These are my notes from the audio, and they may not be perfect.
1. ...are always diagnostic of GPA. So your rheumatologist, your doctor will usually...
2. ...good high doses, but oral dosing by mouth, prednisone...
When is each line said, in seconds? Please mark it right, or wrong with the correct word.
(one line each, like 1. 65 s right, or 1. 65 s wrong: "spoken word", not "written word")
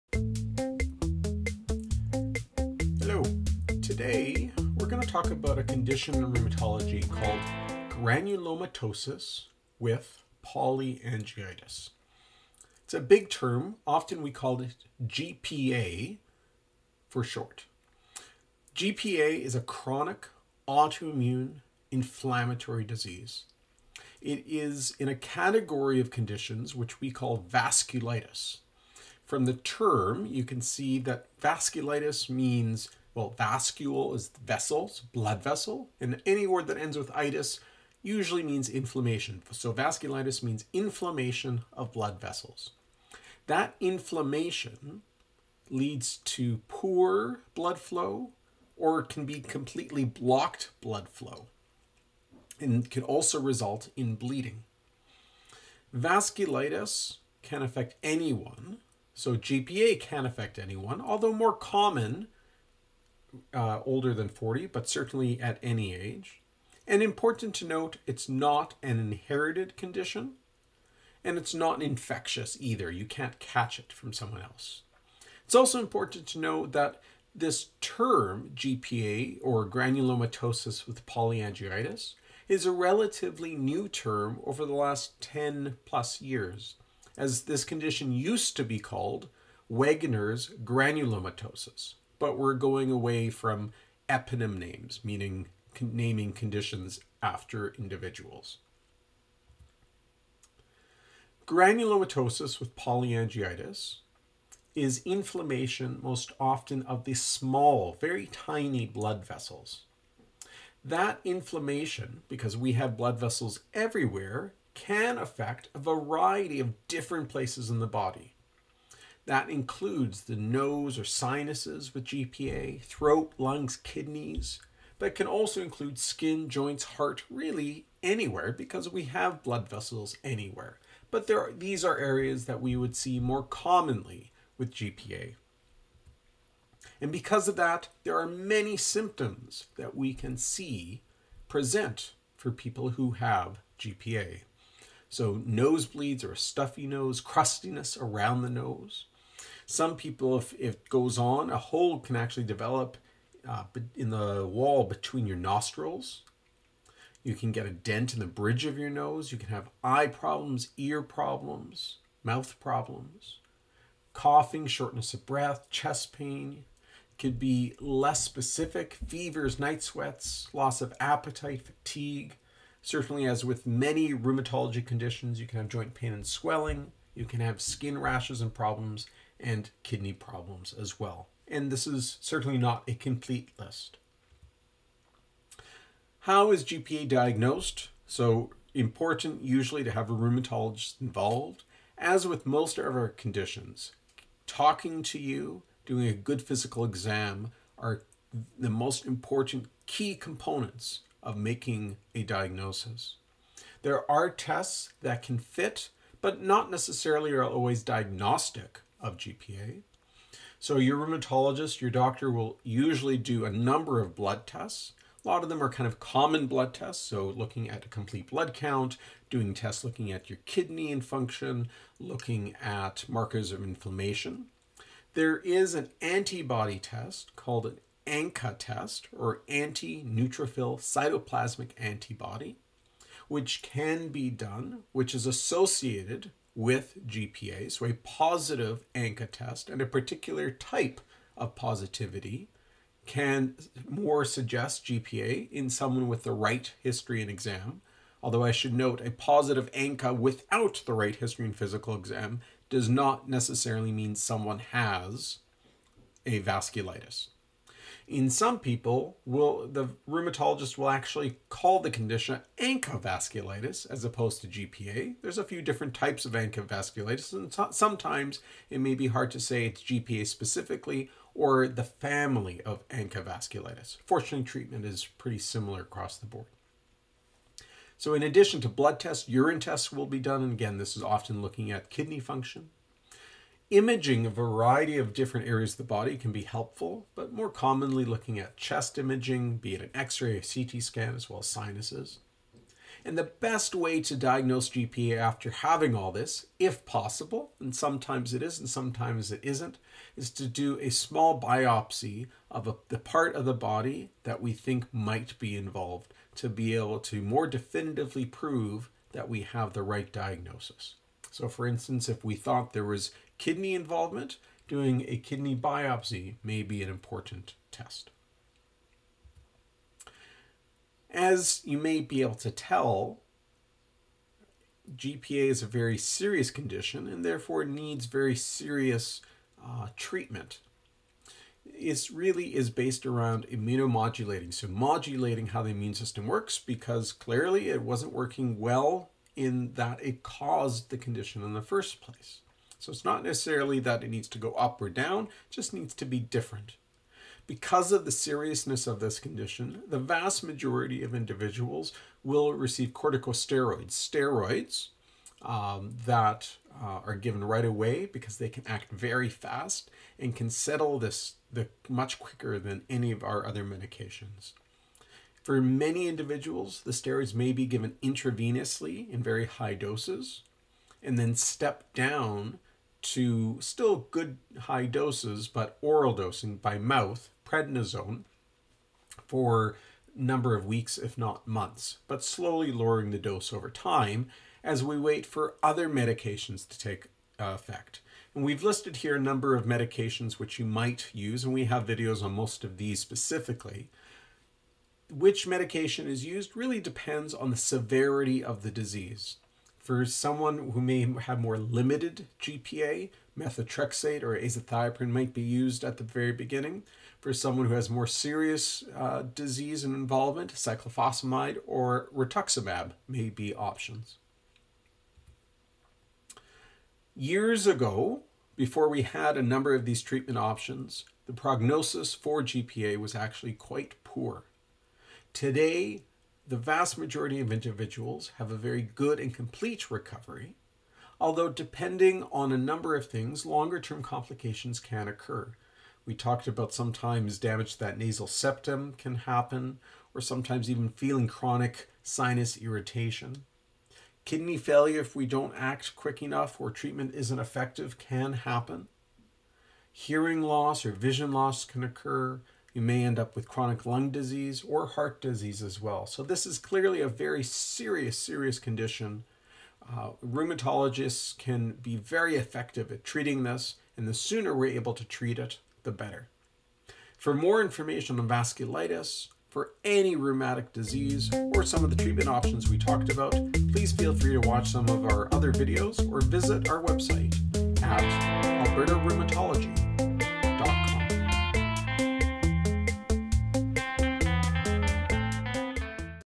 1. 207 s right
2. 374 s right.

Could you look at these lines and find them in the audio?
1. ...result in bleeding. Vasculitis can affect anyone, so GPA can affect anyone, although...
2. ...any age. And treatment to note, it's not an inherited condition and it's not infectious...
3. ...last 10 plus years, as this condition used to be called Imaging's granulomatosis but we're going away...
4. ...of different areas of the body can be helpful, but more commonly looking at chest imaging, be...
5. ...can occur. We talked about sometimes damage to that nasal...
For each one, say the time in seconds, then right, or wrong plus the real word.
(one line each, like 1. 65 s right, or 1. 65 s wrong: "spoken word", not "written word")
1. 53 s right
2. 65 s wrong: "important", not "treatment"
3. 84 s wrong: "Wegener", not "Imaging"
4. 284 s right
5. 434 s right.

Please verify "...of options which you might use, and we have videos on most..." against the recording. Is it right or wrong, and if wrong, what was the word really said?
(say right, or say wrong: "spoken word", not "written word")
wrong: "medications", not "options".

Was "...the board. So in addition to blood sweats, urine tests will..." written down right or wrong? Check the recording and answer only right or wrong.
wrong.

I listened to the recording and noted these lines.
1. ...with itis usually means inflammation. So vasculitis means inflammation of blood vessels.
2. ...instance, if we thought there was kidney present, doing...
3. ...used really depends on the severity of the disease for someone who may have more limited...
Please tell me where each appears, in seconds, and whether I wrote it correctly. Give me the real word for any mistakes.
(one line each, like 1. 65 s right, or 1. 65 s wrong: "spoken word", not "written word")
1. 36 s right
2. 311 s wrong: "involvement", not "present"
3. 396 s right.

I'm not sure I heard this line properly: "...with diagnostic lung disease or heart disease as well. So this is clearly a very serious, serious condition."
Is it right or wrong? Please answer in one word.
wrong.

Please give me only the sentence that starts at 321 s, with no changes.
As you may be able to tell, GPA is a very serious condition and therefore needs very serious uh, treatment.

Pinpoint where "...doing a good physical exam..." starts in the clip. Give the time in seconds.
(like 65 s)
195 s.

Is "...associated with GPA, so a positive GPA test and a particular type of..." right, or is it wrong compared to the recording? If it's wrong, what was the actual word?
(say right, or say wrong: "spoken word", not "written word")
wrong: "ANCA", not "GPA".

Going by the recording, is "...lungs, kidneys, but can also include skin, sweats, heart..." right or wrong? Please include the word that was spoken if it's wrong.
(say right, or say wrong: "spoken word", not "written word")
wrong: "joints", not "sweats".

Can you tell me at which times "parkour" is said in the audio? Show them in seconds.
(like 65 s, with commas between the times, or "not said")
not said.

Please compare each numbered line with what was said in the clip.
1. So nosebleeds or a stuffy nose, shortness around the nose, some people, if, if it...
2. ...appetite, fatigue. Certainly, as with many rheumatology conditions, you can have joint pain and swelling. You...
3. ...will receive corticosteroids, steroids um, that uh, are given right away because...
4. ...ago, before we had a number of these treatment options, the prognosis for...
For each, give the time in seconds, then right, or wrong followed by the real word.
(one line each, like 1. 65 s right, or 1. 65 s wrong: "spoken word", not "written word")
1. 145 s wrong: "crustiness", not "shortness"
2. 170 s right
3. 352 s right
4. 417 s right.